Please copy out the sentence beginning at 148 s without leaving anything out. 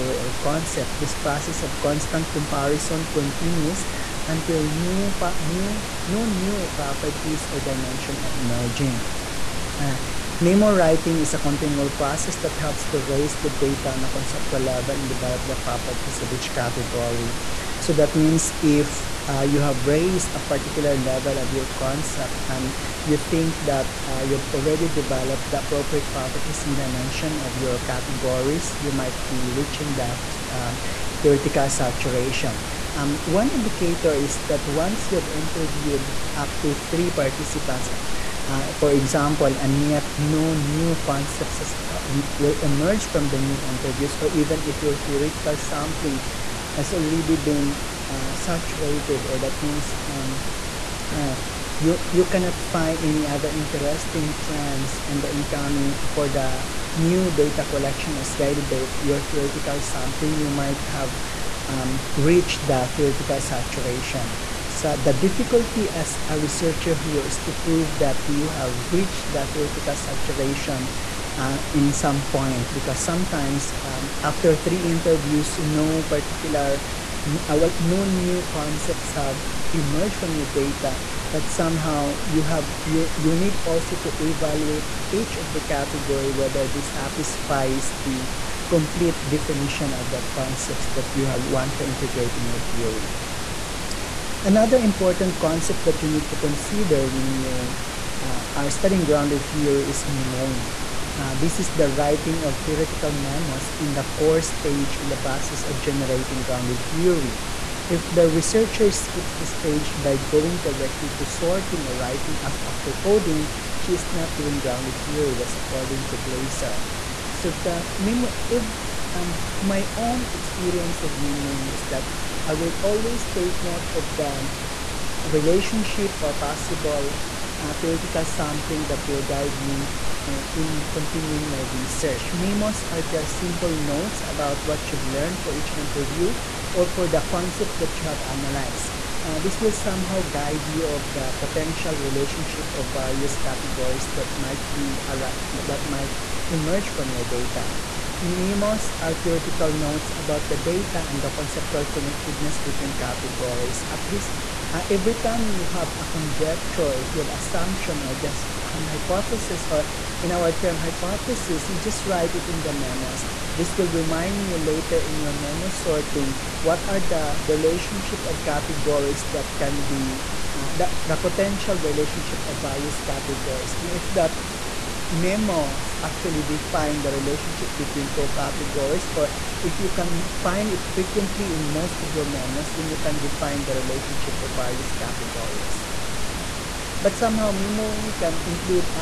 Memos are theoretical notes about the data and the conceptual connectedness between categories.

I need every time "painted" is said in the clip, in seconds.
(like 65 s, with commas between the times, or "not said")
not said.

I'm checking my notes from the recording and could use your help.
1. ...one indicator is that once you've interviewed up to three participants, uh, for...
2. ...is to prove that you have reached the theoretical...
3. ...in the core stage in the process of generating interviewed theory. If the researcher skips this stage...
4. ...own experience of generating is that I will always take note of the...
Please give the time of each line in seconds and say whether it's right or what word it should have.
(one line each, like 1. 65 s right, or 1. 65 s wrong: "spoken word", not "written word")
1. 33 s right
2. 67 s right
3. 103 s wrong: "grounded", not "interviewed"
4. 119 s wrong: "memoing", not "generating".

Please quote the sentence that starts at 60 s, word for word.
You might have um, reached the theoretical saturation.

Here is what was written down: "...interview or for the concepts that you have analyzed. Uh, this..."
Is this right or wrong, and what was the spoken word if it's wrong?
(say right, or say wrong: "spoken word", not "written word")
right.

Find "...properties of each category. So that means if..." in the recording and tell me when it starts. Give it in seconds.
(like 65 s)
15 s.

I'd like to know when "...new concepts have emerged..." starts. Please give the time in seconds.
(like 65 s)
78 s.